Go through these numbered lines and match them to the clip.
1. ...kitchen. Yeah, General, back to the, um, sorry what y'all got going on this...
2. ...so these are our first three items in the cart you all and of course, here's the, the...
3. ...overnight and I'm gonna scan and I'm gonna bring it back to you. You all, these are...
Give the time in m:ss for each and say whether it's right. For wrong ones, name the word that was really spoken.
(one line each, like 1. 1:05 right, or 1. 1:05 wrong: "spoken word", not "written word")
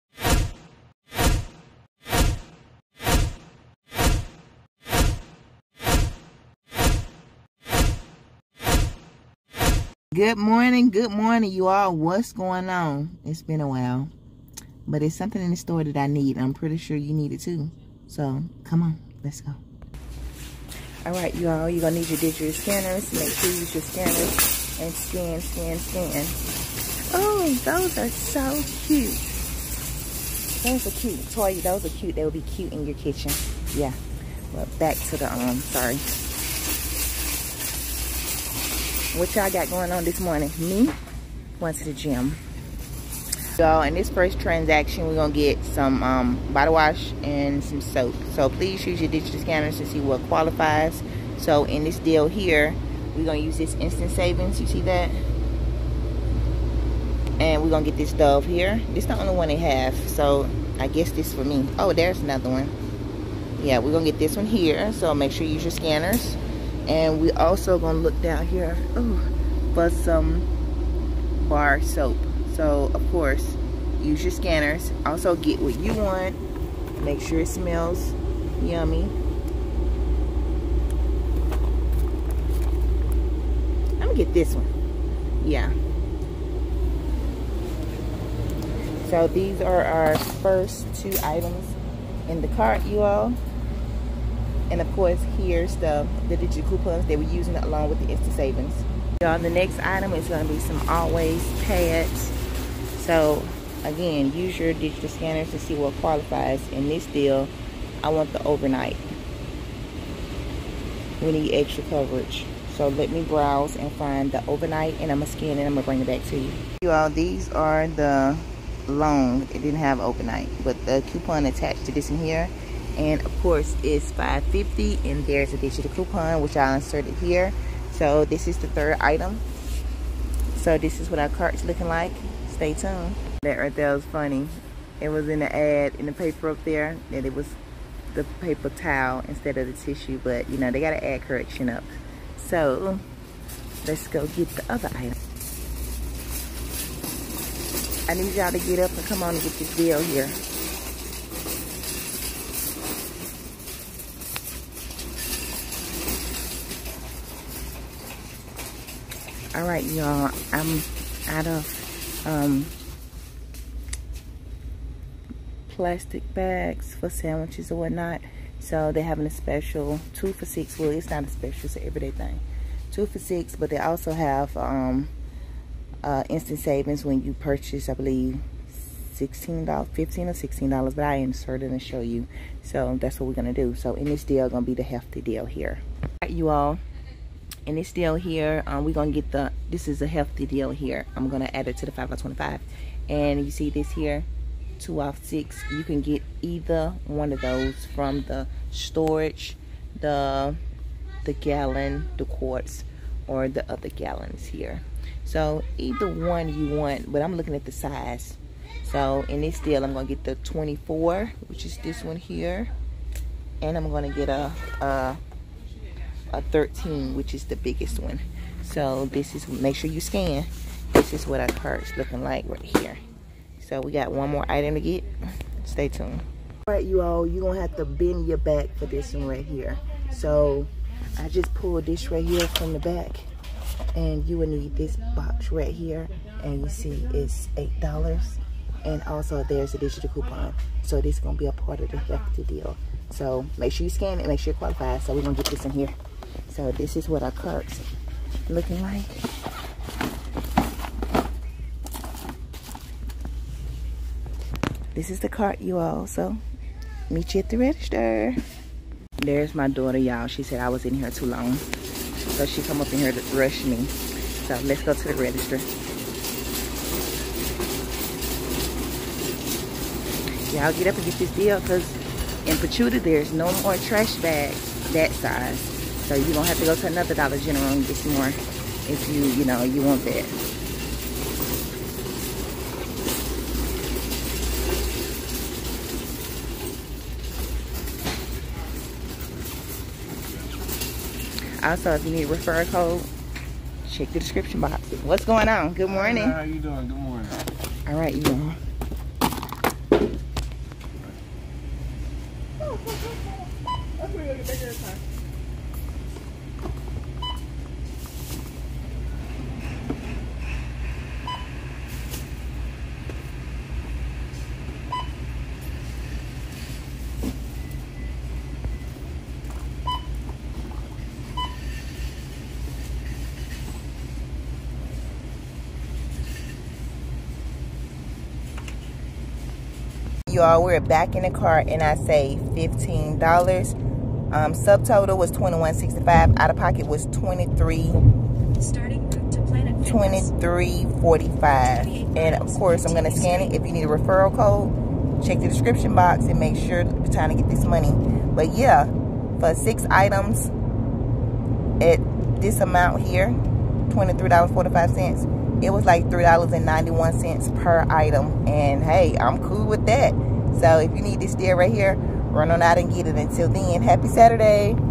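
1. 0:32 wrong: "Well", not "General"
2. 1:29 wrong: "two", not "three"
3. 1:54 right.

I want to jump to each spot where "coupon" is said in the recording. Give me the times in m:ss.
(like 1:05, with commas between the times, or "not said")
1:36, 2:01, 2:05, 4:00.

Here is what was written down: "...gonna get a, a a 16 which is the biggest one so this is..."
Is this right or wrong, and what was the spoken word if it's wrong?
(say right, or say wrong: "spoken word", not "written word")
wrong: "13", not "16".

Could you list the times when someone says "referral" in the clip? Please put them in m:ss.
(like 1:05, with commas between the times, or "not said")
4:52, 5:43.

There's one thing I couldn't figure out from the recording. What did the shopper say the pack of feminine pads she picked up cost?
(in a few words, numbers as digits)
$5.50.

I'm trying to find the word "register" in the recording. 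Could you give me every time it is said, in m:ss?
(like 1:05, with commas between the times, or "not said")
4:17, 4:25.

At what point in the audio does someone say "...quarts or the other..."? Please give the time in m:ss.
3:22.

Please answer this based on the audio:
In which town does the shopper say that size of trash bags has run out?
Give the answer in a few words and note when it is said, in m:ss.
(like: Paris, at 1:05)
Pachuta, at 4:32.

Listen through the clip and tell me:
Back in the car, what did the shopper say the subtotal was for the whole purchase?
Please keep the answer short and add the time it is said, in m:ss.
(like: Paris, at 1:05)
$21.65, at 5:35.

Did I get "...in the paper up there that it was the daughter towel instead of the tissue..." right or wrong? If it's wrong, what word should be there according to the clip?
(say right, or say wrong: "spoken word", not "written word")
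wrong: "paper", not "daughter".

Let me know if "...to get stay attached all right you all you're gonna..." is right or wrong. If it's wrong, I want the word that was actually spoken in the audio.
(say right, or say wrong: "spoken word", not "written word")
wrong: "tuned", not "attached".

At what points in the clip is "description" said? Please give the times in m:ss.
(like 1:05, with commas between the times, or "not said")
4:54, 5:45.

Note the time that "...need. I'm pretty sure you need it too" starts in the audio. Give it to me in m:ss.
0:16.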